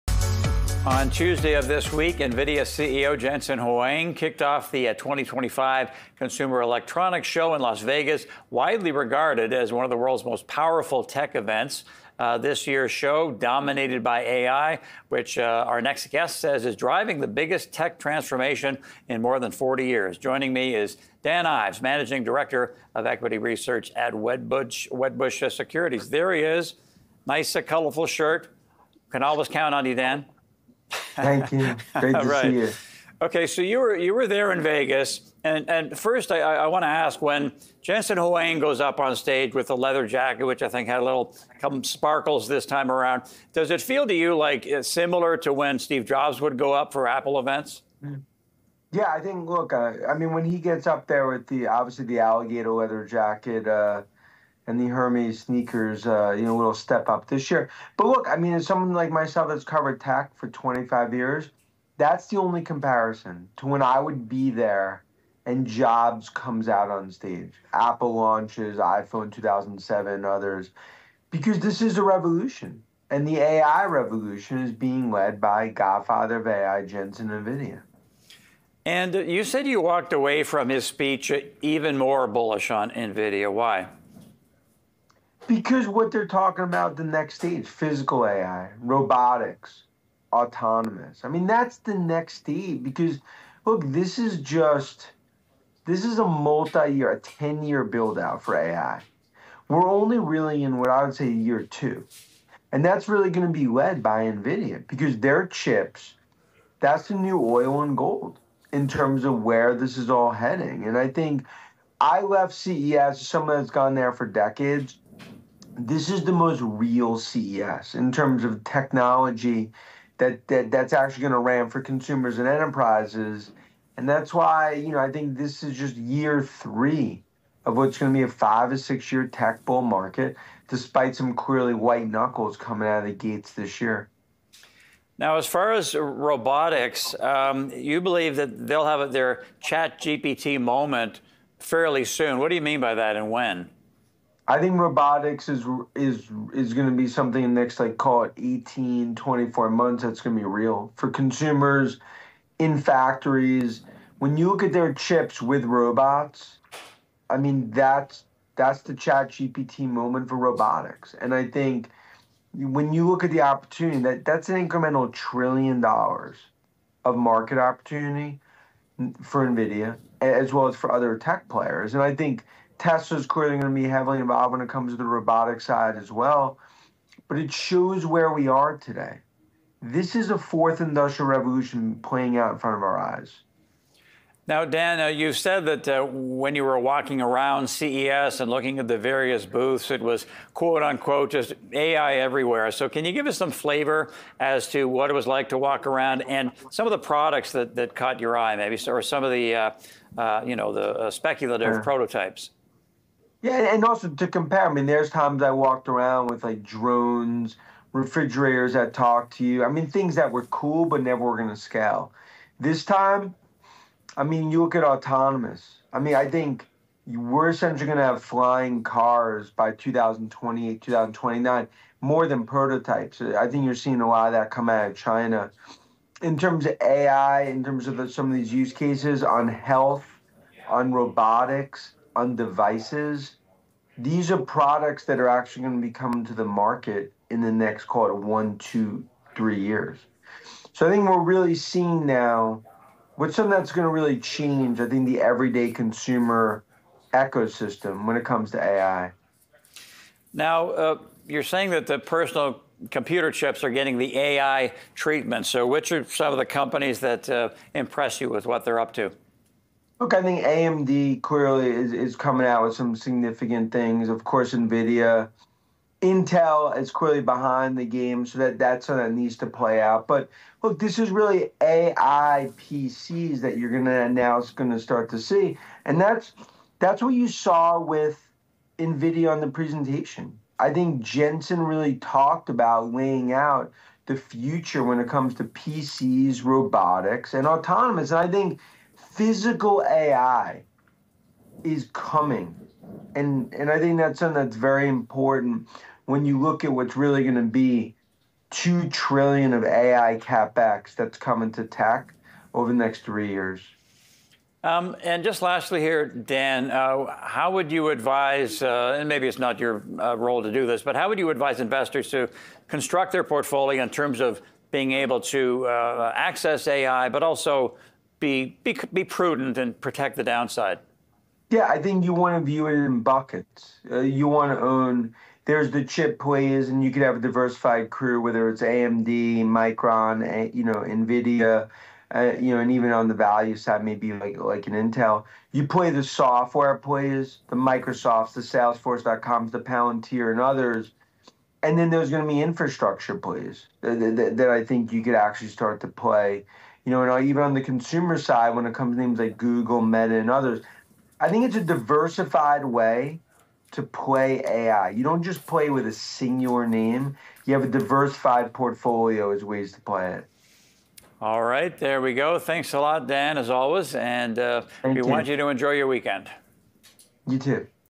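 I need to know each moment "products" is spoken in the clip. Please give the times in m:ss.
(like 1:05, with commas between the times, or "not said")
3:16, 3:54.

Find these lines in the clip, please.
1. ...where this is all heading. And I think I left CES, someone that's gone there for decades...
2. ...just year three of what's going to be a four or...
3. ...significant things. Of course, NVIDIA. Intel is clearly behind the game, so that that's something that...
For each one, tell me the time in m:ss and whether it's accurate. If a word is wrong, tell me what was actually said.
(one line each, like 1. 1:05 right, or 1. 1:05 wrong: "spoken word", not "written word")
1. 1:49 right
2. 2:05 wrong: "five", not "four"
3. 4:22 right.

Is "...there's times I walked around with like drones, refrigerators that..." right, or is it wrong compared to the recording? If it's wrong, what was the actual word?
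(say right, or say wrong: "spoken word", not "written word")
right.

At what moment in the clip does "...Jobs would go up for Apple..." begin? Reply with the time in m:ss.
0:46.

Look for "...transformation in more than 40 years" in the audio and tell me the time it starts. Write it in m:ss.
0:17.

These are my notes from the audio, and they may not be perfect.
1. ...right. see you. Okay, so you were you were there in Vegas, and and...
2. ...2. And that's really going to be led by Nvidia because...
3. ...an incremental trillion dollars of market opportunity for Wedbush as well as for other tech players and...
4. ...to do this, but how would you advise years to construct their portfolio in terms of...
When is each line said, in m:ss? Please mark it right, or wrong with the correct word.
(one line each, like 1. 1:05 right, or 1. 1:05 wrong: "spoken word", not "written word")
1. 0:32 right
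2. 1:41 right
3. 2:44 wrong: "Nvidia", not "Wedbush"
4. 5:10 wrong: "investors", not "years".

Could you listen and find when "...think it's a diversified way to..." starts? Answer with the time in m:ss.
5:51.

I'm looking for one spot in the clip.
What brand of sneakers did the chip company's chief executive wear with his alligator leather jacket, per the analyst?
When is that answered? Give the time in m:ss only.
0:54.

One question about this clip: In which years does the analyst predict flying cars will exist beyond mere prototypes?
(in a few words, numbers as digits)
2028, 2029.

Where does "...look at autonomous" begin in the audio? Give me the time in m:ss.
3:34.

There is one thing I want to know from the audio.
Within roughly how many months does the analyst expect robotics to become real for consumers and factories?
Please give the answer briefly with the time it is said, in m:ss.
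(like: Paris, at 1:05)
18 to 24 months, at 2:28.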